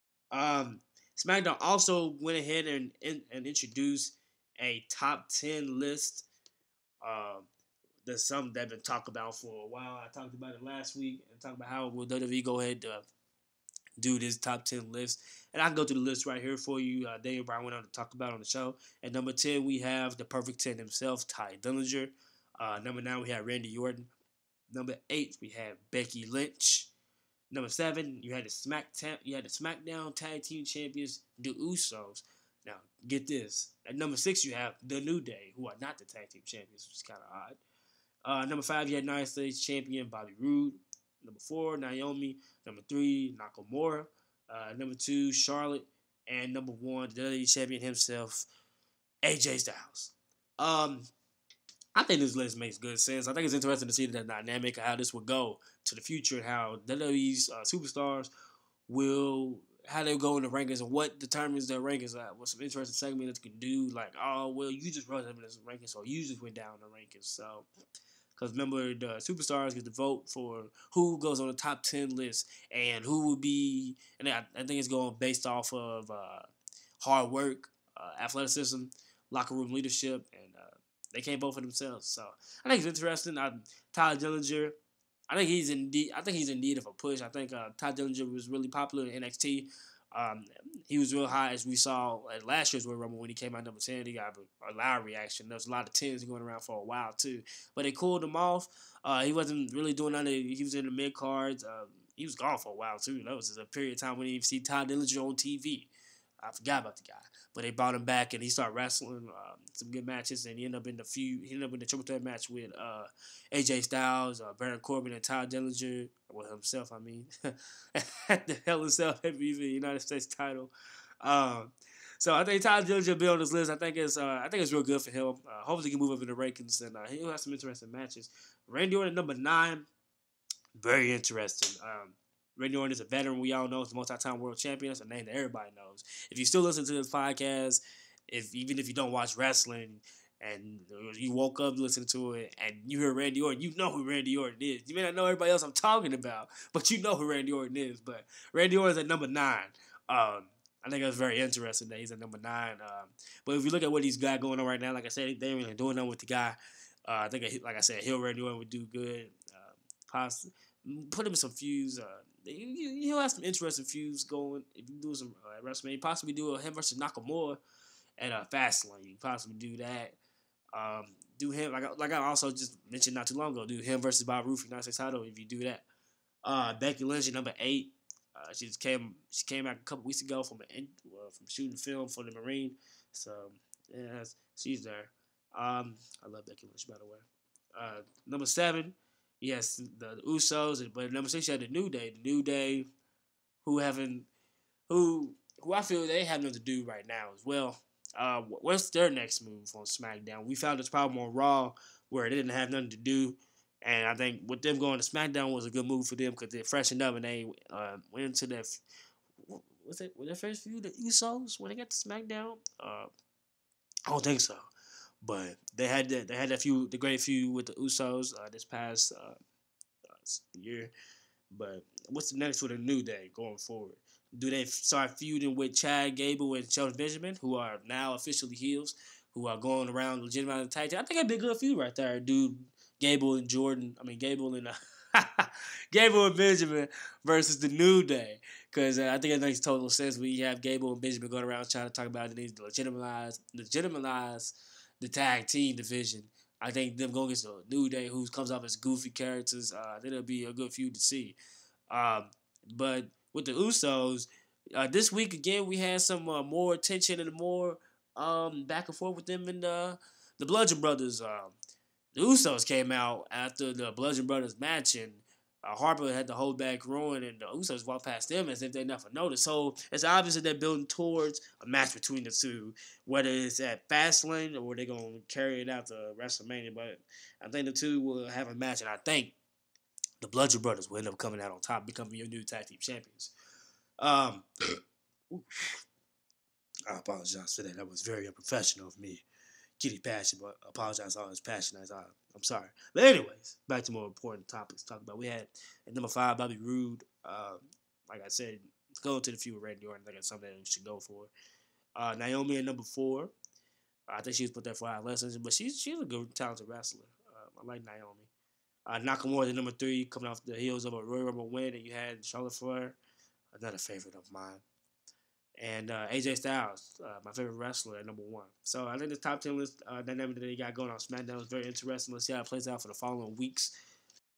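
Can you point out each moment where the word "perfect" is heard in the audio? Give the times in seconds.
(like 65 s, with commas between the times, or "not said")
20 s.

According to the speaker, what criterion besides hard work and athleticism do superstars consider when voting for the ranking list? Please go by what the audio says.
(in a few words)
Locker room leadership.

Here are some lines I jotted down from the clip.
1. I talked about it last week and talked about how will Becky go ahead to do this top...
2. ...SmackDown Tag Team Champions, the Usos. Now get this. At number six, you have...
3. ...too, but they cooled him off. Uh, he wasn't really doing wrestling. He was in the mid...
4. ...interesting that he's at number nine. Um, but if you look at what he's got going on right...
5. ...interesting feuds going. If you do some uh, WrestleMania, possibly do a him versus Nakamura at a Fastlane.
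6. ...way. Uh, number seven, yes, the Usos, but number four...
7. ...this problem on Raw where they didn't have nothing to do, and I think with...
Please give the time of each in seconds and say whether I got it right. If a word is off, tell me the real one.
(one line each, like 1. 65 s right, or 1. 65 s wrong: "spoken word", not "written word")
1. 10 s wrong: "WWE", not "Becky"
2. 29 s right
3. 97 s wrong: "nothing", not "wrestling"
4. 151 s right
5. 163 s right
6. 187 s wrong: "six", not "four"
7. 200 s right.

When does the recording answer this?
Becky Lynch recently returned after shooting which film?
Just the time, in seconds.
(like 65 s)
182 s.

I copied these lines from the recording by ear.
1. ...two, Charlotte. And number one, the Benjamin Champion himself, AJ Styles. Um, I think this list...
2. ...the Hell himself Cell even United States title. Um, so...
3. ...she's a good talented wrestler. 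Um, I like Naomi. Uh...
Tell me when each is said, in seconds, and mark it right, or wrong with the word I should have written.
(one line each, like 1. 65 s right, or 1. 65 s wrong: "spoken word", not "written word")
1. 44 s wrong: "WWE", not "Benjamin"
2. 118 s right
3. 305 s right.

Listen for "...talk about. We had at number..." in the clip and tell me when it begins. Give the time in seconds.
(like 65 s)
294 s.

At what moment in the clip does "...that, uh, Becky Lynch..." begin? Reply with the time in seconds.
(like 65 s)
175 s.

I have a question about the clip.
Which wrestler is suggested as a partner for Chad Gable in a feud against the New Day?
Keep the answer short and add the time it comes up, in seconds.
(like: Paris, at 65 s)
Shelton Benjamin, at 226 s.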